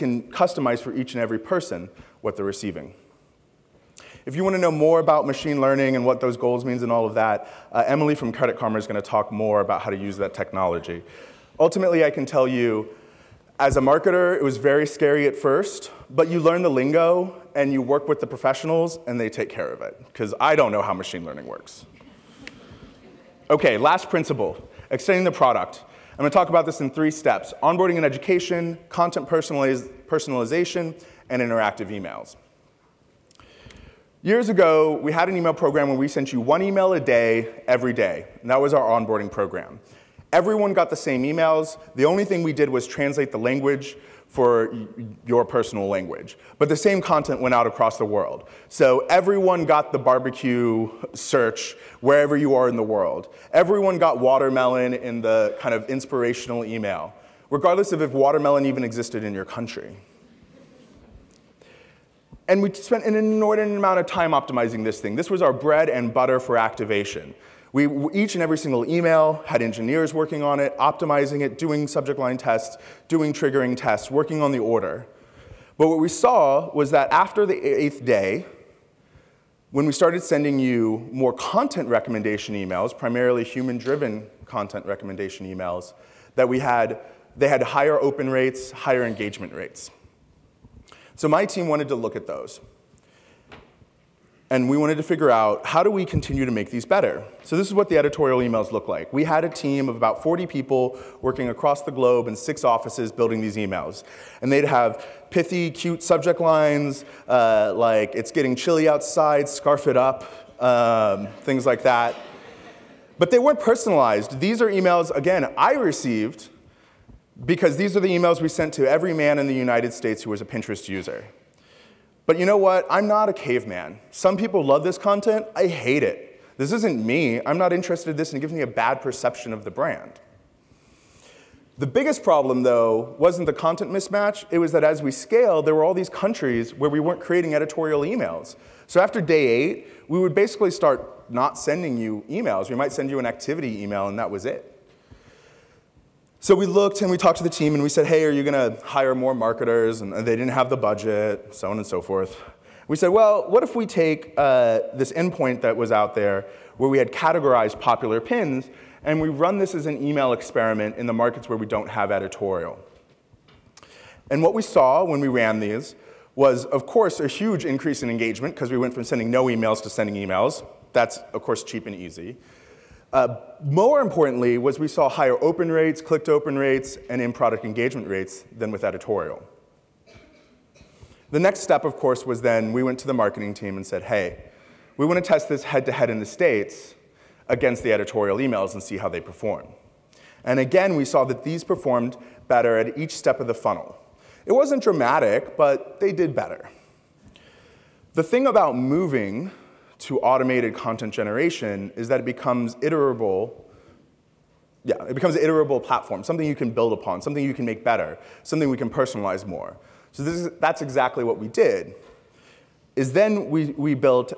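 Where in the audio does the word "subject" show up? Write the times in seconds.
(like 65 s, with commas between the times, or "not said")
71 s, 106 s.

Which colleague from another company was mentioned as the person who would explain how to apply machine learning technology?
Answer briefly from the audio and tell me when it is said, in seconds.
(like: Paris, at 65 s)
Emily, at 7 s.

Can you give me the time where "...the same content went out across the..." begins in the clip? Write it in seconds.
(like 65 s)
46 s.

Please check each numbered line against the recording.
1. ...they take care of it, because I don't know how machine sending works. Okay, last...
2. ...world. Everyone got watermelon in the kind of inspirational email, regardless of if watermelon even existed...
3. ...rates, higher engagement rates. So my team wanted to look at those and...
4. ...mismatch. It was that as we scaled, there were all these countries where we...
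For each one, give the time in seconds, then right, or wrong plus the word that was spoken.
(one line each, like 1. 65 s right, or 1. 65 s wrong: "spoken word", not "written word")
1. 19 s wrong: "learning", not "sending"
2. 52 s right
3. 88 s right
4. 133 s right.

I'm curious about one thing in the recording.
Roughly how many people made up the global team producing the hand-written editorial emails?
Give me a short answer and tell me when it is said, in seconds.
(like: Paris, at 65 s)
40, at 99 s.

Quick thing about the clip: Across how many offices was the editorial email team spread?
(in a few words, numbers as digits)
6.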